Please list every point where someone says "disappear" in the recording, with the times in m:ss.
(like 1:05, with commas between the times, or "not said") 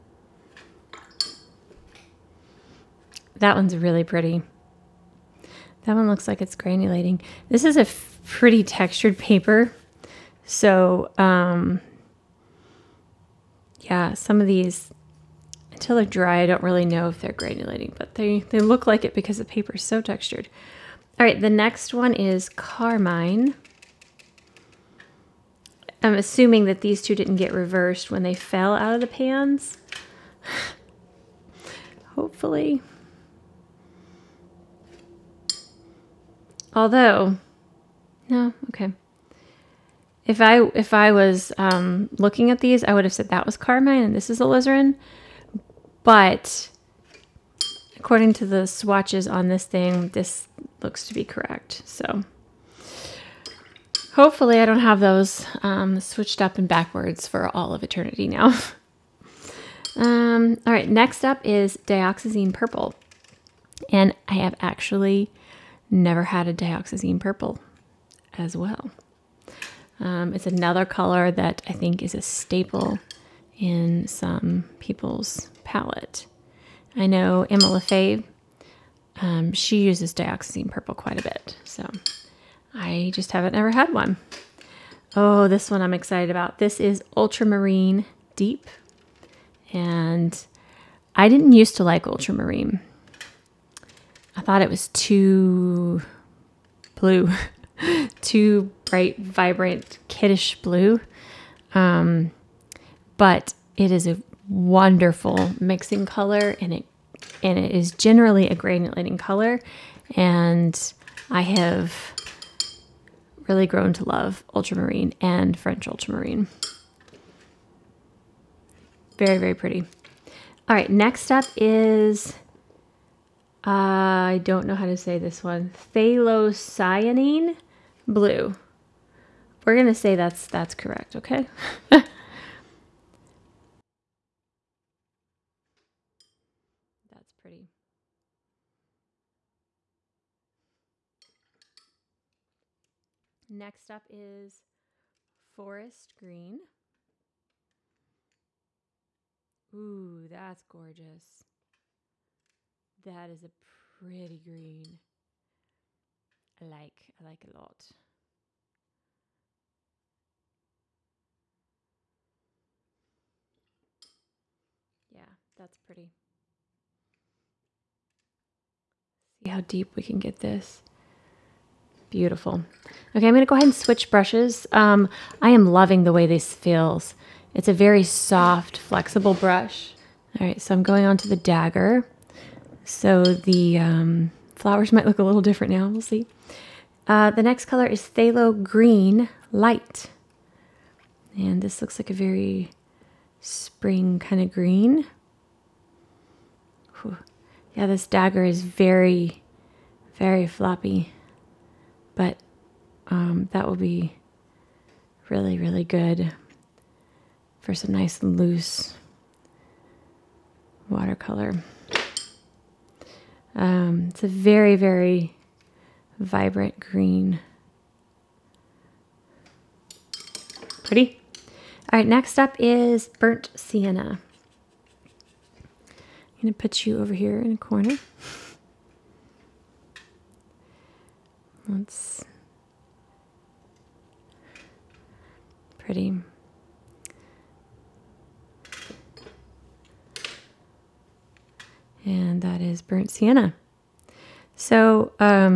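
not said.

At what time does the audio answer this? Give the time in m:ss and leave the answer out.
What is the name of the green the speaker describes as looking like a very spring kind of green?
3:08.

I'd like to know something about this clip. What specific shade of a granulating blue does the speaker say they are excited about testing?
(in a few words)
Ultramarine Deep.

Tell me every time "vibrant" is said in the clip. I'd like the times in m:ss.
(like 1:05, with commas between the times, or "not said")
1:39, 3:36.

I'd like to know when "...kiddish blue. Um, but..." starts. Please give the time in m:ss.
1:40.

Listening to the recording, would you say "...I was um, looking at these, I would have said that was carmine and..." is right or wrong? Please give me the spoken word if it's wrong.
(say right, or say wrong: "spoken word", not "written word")
right.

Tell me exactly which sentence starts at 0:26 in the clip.
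I'm assuming that these two didn't get reversed when they fell out of the pans.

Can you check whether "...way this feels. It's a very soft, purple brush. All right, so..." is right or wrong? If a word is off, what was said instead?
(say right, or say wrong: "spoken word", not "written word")
wrong: "flexible", not "purple".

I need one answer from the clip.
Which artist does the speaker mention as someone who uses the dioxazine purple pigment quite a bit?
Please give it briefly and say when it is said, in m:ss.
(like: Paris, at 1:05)
Emma Lefebvre, at 1:17.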